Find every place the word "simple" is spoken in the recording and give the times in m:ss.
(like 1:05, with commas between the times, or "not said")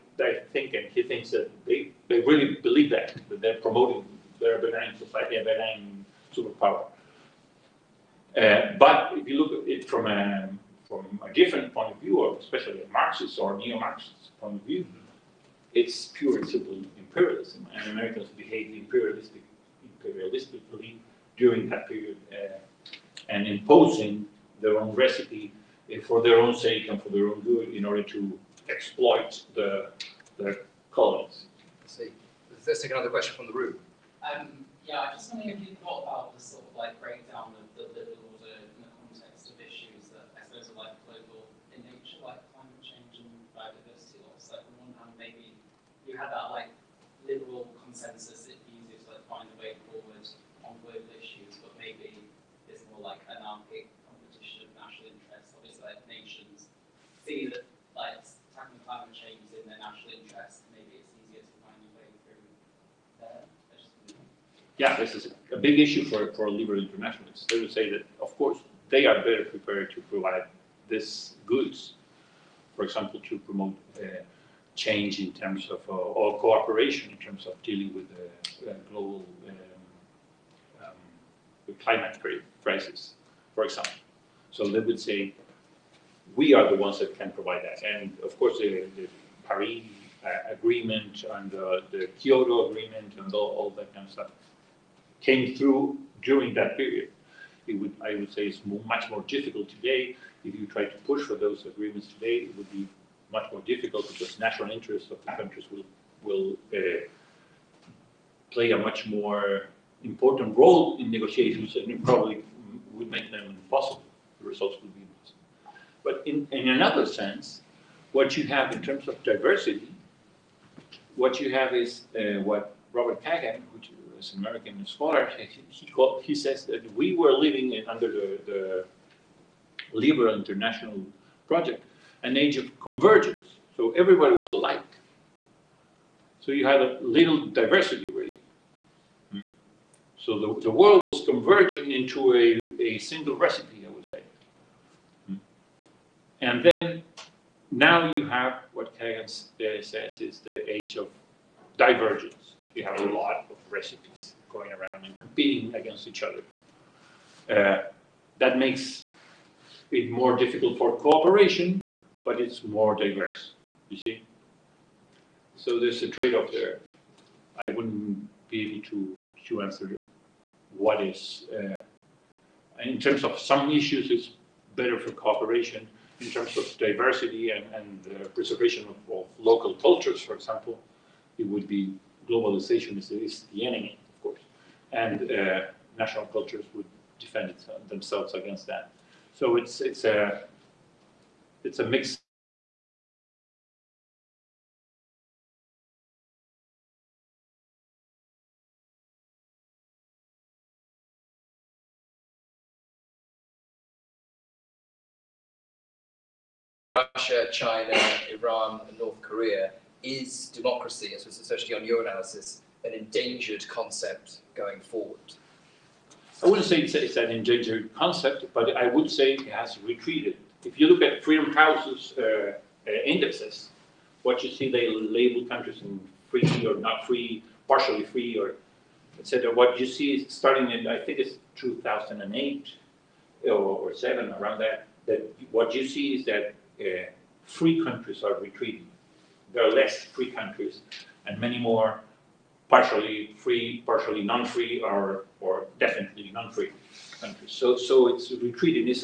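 0:16.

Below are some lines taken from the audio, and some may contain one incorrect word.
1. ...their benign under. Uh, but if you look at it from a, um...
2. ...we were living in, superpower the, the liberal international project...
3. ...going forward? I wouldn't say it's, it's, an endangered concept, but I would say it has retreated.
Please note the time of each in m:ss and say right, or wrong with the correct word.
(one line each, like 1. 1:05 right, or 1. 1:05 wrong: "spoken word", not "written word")
1. 0:05 wrong: "superpower", not "under"
2. 2:06 wrong: "under", not "superpower"
3. 3:34 right.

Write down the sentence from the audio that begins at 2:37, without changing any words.
Uh, that makes it more difficult for cooperation, but it's more diverse, you see?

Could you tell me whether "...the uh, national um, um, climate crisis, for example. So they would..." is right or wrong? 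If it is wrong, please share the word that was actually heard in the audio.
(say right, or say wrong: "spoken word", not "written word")
wrong: "global", not "national".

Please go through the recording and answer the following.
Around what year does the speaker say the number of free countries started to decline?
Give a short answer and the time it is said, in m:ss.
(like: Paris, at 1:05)
2008, at 3:51.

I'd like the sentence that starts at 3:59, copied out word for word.
There are less free countries and many more partially free, partially non-free, or, or definitely non-free countries.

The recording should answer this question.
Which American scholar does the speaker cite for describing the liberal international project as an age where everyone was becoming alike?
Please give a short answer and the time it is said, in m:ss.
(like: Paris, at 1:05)
Robert Kagan, at 2:02.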